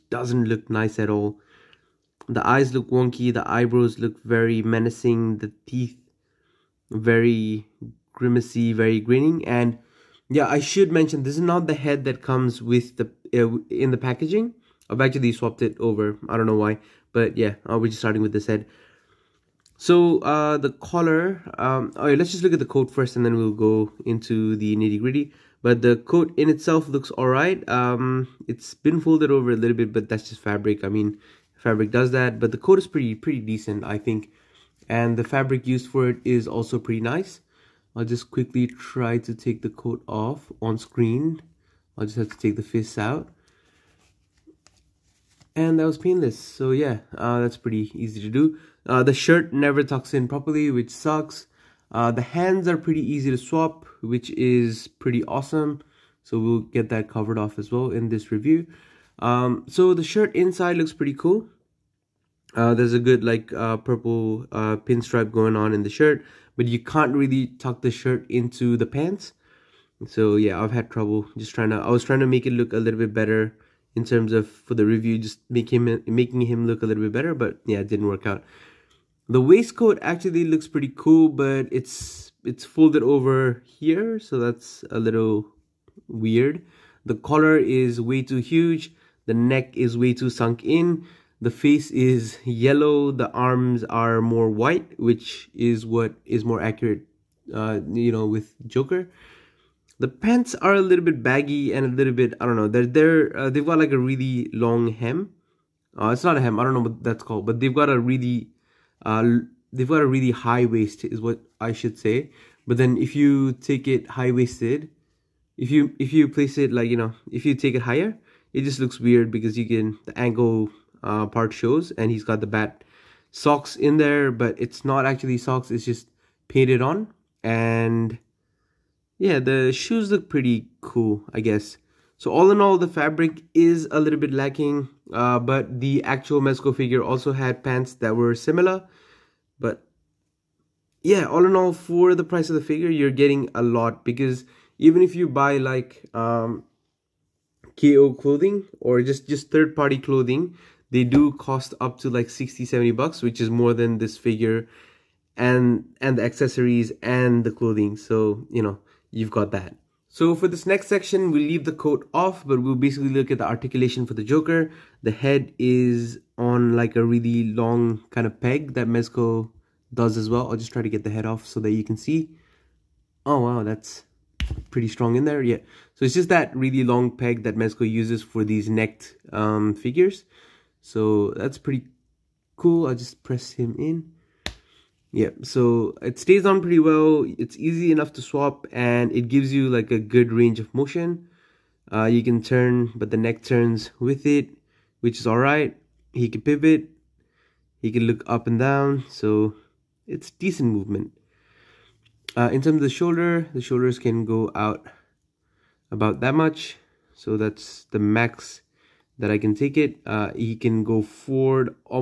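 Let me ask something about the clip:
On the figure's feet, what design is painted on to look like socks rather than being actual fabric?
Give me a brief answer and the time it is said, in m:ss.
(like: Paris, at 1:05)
Bat socks, at 2:02.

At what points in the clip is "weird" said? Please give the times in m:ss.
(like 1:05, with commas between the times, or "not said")
1:26, 1:58.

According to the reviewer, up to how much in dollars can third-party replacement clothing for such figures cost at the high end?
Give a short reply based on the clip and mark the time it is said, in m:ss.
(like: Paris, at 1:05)
70, at 2:32.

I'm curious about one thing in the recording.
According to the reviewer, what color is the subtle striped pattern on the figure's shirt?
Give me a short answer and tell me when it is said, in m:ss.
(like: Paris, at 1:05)
Purple, at 1:03.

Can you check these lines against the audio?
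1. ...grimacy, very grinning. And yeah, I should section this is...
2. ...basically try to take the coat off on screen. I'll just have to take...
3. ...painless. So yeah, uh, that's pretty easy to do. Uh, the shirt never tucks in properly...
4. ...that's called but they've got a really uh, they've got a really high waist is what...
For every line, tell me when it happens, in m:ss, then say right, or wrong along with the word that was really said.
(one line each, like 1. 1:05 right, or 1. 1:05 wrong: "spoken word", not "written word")
1. 0:08 wrong: "mention", not "section"
2. 0:38 wrong: "quickly", not "basically"
3. 0:45 right
4. 1:47 right.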